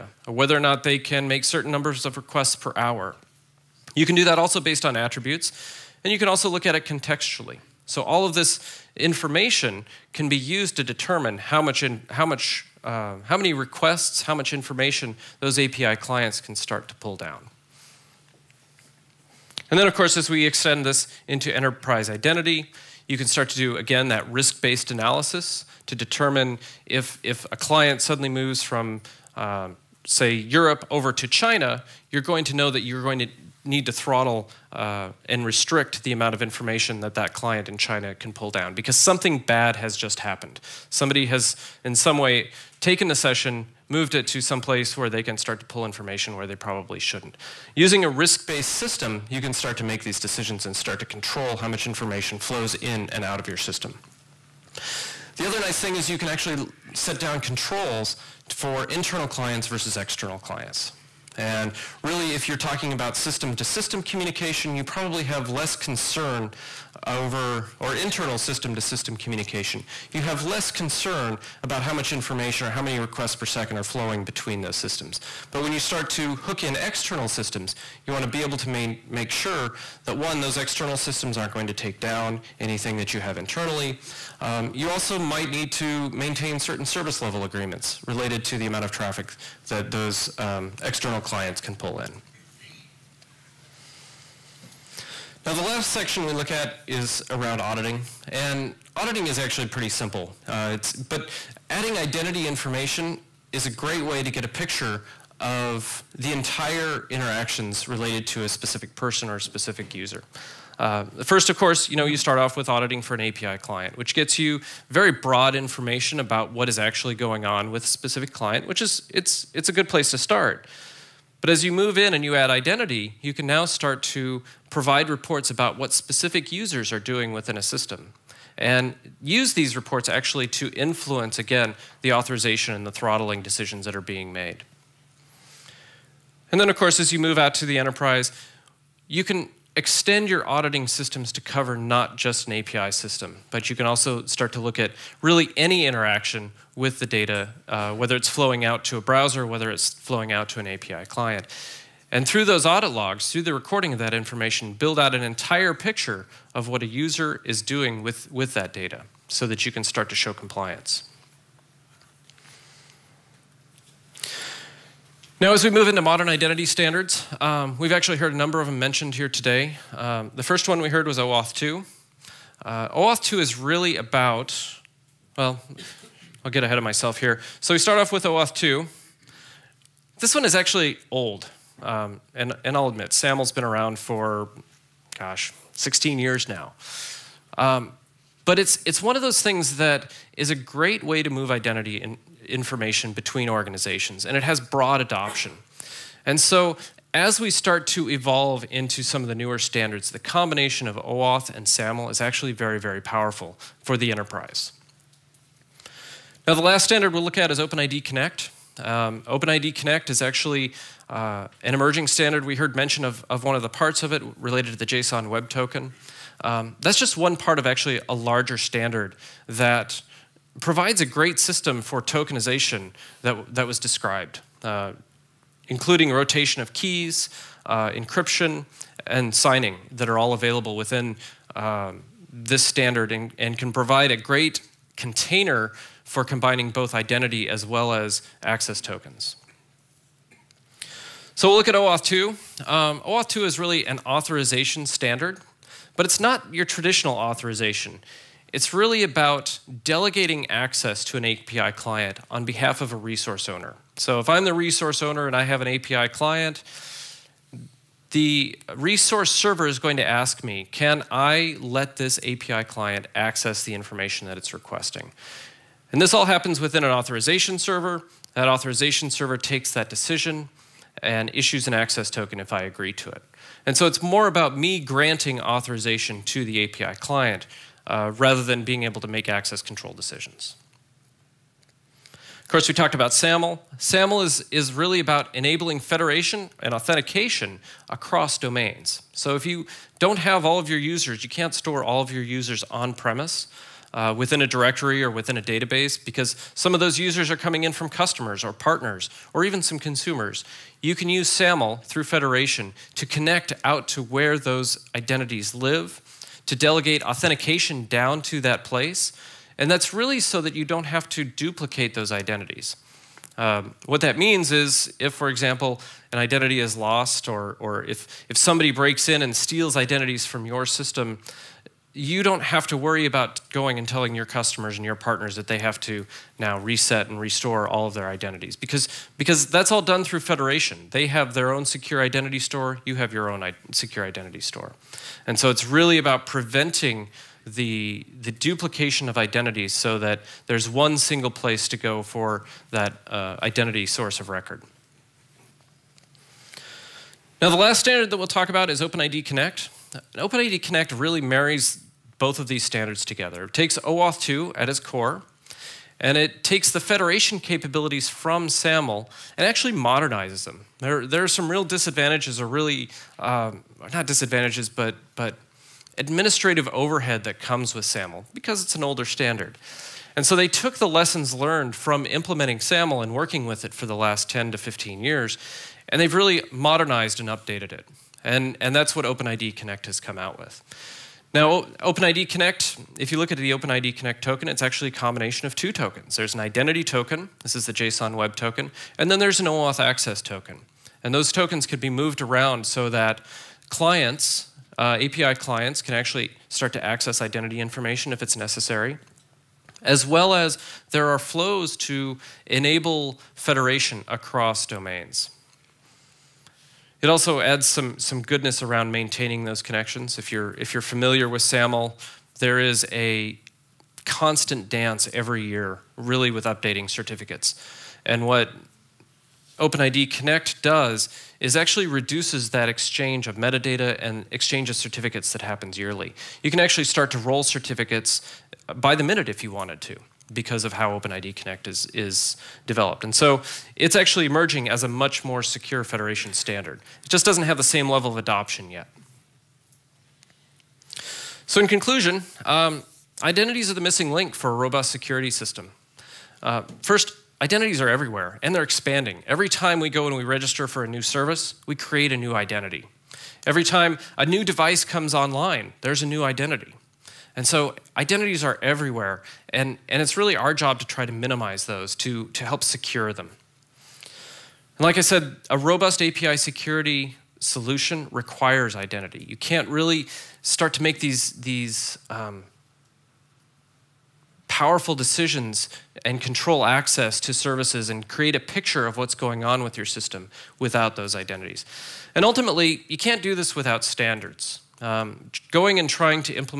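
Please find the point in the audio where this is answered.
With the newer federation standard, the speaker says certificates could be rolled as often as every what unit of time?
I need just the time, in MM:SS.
07:08.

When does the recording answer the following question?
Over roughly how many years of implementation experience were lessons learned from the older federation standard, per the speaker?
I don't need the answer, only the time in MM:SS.
06:14.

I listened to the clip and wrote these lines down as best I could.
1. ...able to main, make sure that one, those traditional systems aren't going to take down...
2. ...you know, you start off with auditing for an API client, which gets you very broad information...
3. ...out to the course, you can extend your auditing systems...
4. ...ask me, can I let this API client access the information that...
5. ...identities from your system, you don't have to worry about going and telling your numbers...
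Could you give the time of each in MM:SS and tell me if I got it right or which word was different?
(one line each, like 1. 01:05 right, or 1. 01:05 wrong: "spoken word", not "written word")
1. 01:18 wrong: "external", not "traditional"
2. 01:51 right
3. 02:17 wrong: "enterprise", not "course"
4. 04:20 right
5. 05:19 wrong: "customers", not "numbers".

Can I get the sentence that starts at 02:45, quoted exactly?
Now, as we move into modern identity standards, um, we've actually heard a number of them mentioned here today.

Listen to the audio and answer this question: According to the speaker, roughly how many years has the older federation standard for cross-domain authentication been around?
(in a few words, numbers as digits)
16 years.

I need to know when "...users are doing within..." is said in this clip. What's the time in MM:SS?
02:06.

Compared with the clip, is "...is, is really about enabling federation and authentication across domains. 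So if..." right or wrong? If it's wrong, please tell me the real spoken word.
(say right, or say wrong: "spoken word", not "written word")
right.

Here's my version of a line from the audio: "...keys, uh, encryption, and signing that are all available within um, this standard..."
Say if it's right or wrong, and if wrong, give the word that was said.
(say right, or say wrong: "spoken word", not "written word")
right.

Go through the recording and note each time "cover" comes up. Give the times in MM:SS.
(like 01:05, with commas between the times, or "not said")
02:21.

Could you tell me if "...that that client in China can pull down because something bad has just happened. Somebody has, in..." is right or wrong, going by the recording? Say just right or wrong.
right.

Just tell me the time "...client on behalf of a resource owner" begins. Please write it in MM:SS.
04:11.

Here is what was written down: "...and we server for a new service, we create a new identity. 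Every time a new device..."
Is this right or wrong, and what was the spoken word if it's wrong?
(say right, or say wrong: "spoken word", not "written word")
wrong: "register", not "server".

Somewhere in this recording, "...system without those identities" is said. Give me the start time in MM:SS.
07:59.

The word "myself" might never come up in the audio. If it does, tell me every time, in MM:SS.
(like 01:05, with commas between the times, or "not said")
02:56.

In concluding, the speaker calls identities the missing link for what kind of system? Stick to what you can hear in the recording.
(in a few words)
robust security system.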